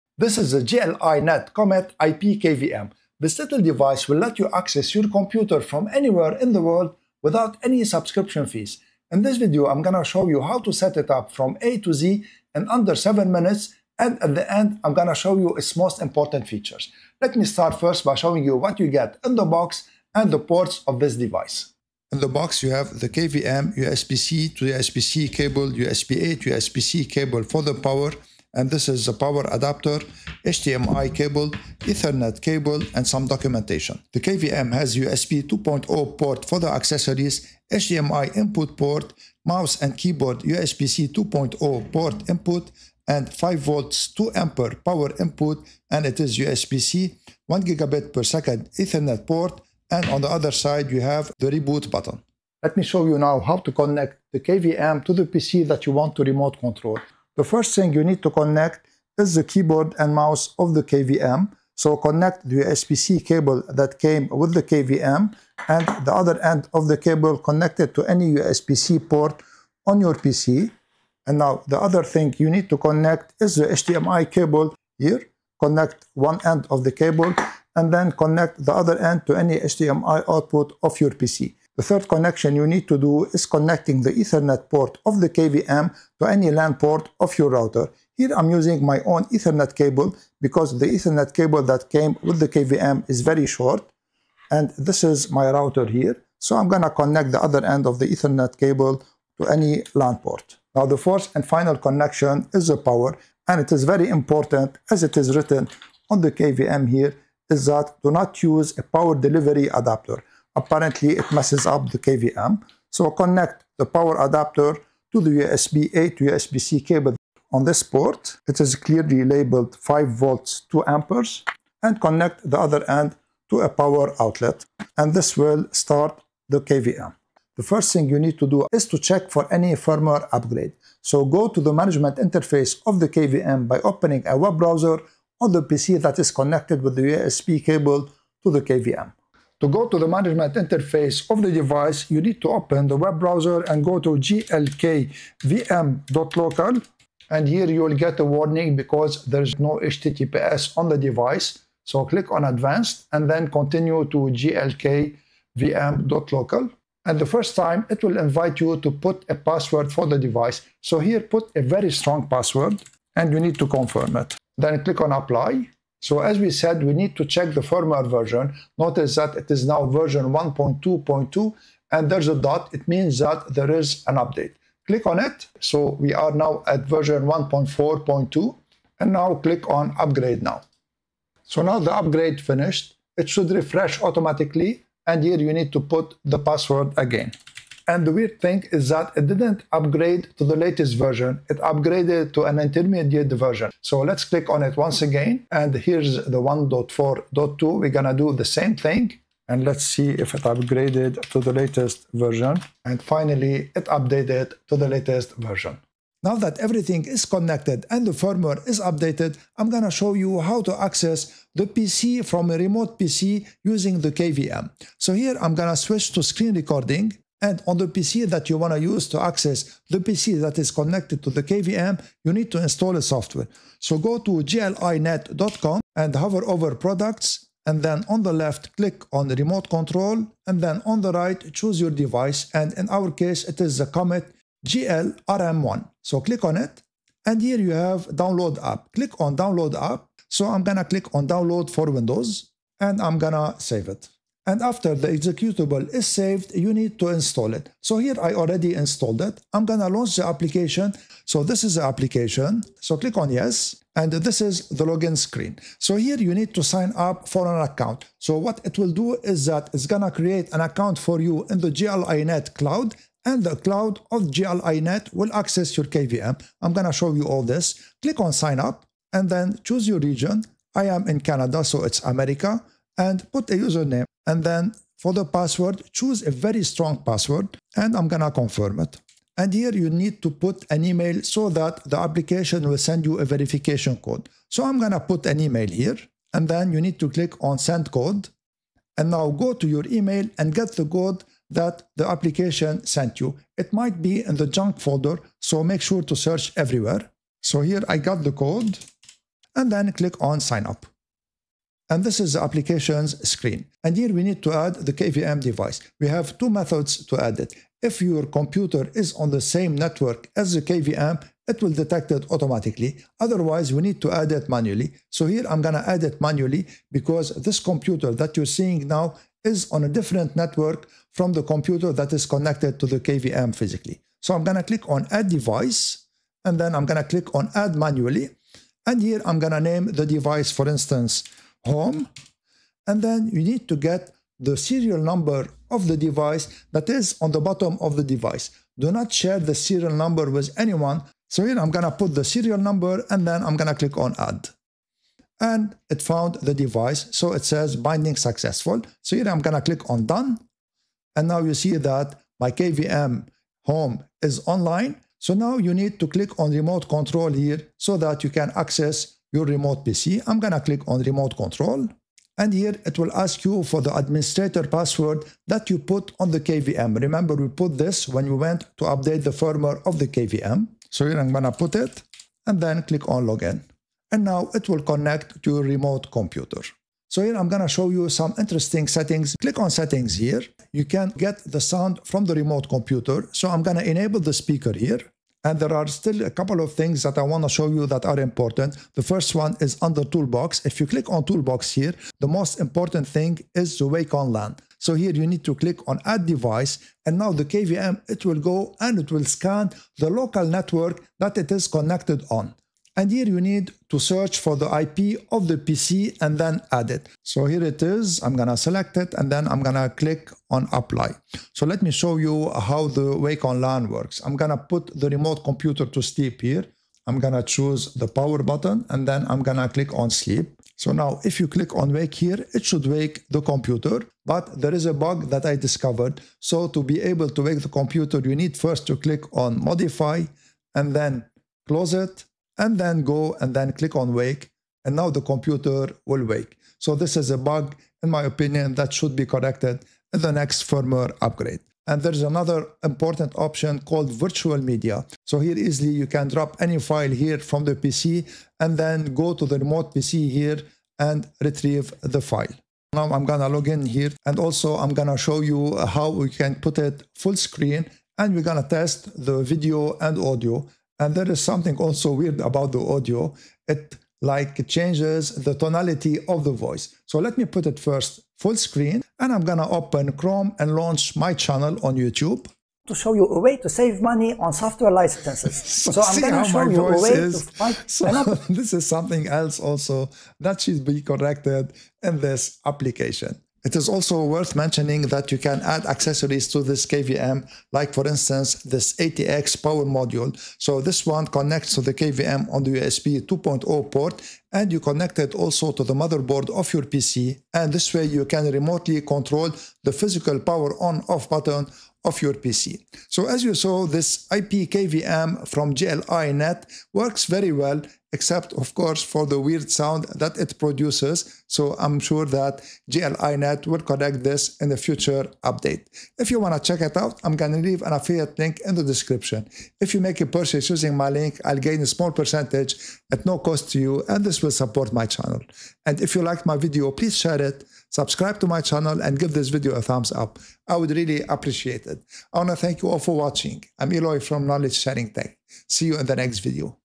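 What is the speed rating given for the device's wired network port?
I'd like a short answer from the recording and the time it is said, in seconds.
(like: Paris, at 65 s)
1 gigabit per second, at 47 s.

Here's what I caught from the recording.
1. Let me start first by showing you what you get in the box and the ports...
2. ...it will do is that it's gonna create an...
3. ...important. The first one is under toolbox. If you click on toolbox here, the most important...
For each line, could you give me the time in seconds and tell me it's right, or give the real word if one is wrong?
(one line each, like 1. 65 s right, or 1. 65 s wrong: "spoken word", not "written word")
1. 17 s right
2. 258 s right
3. 388 s right.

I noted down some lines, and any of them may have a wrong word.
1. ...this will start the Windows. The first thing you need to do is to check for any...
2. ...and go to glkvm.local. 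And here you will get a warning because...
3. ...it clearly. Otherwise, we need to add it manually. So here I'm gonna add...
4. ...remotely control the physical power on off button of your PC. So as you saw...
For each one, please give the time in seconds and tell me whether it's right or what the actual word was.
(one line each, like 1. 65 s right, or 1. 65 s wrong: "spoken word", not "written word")
1. 125 s wrong: "KVM", not "Windows"
2. 143 s right
3. 312 s wrong: "automatically", not "clearly"
4. 498 s right.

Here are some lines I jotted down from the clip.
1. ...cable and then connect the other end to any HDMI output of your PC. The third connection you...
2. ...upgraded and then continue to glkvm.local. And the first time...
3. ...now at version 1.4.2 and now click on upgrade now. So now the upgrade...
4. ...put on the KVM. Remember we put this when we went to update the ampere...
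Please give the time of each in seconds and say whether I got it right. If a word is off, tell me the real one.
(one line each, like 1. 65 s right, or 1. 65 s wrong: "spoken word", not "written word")
1. 76 s right
2. 152 s wrong: "advanced", not "upgraded"
3. 176 s right
4. 365 s wrong: "firmware", not "ampere".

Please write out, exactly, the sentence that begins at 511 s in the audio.
So I'm sure that GL-iNet will correct this in the future update.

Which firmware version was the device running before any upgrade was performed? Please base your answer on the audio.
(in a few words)
1.2.2.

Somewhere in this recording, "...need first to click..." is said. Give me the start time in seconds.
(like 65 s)
428 s.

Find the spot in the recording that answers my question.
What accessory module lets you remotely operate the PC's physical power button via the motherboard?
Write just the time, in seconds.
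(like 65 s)
488 s.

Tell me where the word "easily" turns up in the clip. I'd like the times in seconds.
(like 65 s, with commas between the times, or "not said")
445 s.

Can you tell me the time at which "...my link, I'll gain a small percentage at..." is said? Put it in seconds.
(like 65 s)
520 s.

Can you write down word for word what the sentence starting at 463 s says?
It like changes the tonality of the voice.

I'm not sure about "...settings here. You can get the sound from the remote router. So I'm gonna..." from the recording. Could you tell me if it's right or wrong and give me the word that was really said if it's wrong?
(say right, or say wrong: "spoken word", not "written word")
wrong: "computer", not "router".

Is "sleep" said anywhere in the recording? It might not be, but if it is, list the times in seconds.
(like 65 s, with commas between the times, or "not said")
416 s, 420 s.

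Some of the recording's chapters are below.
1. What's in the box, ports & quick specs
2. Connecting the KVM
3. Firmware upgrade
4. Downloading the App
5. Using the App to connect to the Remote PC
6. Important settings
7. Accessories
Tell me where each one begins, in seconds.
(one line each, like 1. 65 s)
1. 21 s
2. 51 s
3. 137 s
4. 205 s
5. 249 s
6. 376 s
7. 483 s.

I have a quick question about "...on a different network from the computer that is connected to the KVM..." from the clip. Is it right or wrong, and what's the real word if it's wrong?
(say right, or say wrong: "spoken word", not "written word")
right.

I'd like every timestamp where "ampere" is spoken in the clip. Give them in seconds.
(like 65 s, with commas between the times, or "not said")
44 s, 120 s.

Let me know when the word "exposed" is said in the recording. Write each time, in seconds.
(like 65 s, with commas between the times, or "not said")
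not said.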